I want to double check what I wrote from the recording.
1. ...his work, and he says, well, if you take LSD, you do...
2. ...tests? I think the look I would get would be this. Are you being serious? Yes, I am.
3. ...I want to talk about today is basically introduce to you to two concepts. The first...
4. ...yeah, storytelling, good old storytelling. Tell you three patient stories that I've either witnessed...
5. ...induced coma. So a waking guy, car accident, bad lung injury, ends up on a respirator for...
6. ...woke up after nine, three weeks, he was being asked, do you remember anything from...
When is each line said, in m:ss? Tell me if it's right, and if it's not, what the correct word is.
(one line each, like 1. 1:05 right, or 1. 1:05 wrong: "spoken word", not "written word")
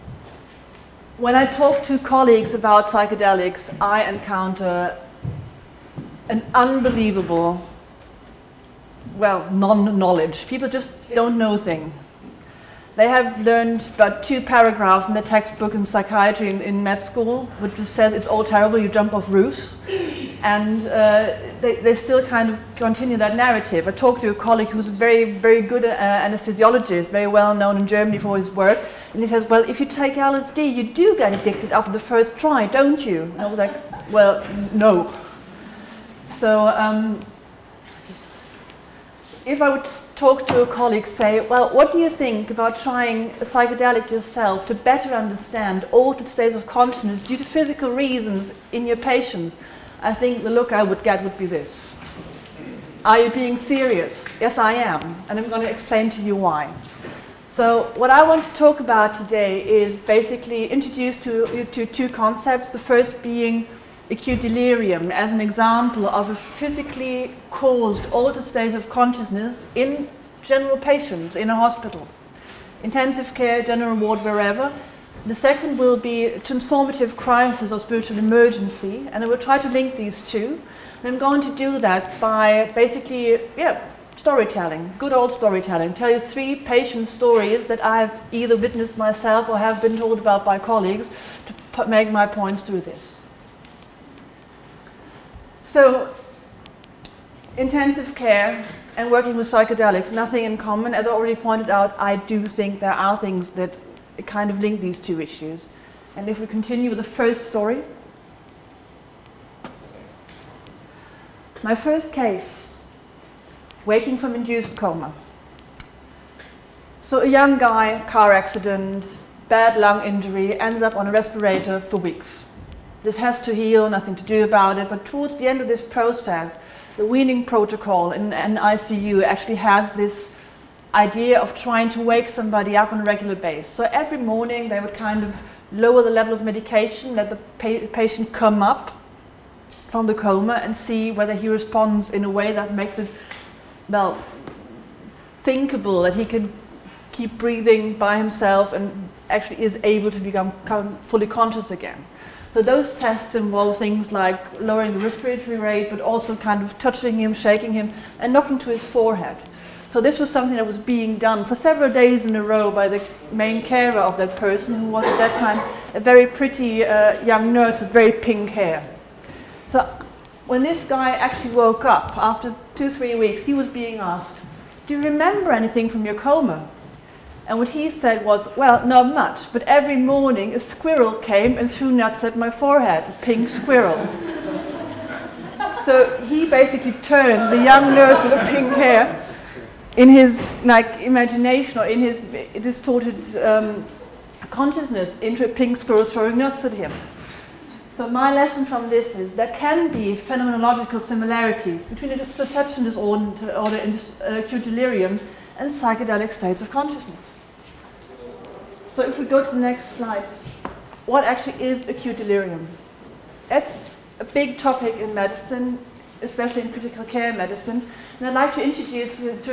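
1. 0:28 right
2. 0:49 wrong: "patients", not "tests"
3. 0:58 right
4. 1:23 right
5. 1:54 wrong: "young", not "waking"
6. 2:51 wrong: "two", not "nine".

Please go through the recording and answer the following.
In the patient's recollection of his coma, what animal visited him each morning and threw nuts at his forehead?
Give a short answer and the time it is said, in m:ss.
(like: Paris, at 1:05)
A pink squirrel, at 3:03.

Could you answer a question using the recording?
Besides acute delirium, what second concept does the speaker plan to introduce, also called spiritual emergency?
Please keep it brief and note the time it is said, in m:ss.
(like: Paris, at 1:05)
Transformative crisis, at 1:16.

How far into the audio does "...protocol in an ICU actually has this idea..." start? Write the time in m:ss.
2:07.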